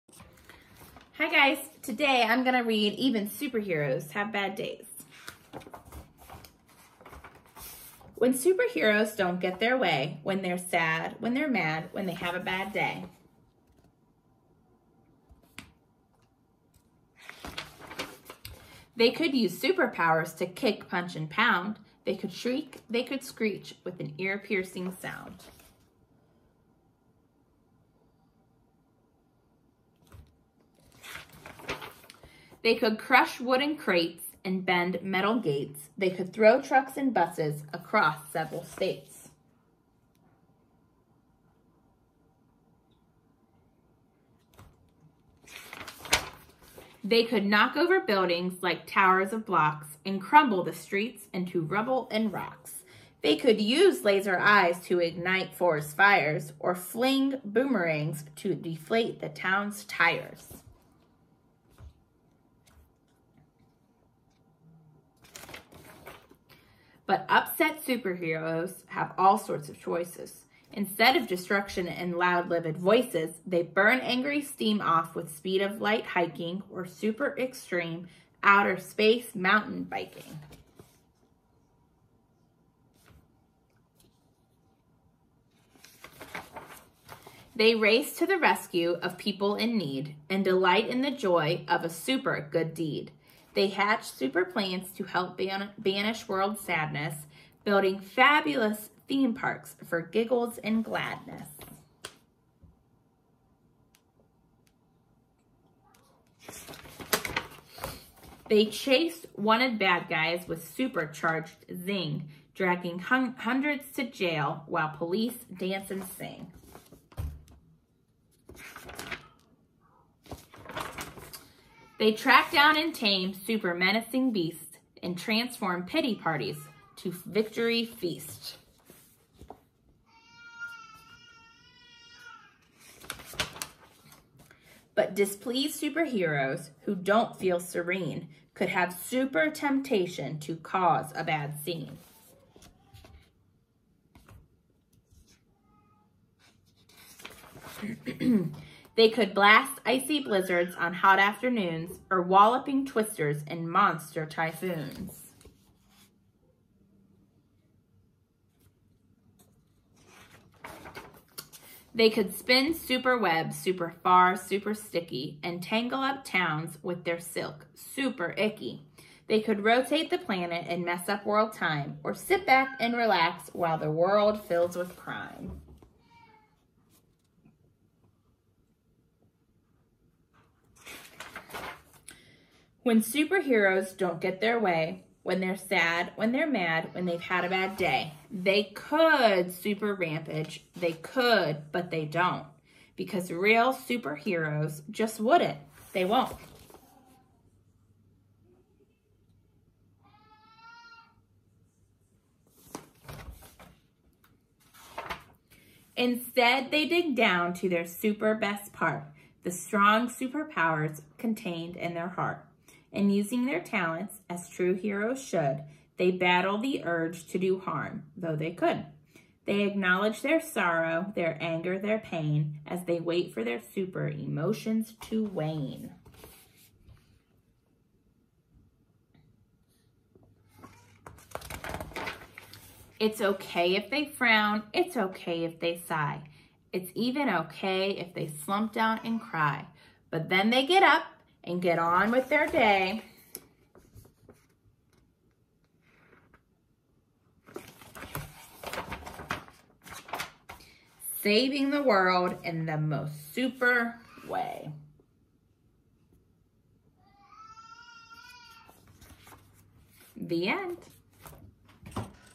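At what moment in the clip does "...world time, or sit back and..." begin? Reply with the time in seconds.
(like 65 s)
171 s.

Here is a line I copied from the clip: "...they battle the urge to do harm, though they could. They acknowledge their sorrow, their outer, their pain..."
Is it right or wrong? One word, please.
wrong.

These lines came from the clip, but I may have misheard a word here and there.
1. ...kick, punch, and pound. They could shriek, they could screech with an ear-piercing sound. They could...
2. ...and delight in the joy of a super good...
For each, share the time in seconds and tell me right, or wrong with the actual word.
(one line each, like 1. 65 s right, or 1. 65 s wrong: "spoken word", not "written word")
1. 20 s right
2. 90 s right.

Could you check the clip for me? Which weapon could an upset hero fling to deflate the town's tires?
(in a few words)
boomerangs.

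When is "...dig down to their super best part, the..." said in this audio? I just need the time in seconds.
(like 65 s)
206 s.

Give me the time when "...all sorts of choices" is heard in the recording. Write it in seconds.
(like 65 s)
69 s.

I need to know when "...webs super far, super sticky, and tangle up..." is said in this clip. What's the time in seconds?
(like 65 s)
163 s.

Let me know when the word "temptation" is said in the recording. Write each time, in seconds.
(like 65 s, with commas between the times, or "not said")
139 s.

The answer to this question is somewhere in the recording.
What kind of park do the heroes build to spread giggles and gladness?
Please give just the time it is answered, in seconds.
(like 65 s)
99 s.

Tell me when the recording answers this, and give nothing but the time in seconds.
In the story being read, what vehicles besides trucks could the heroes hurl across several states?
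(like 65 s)
37 s.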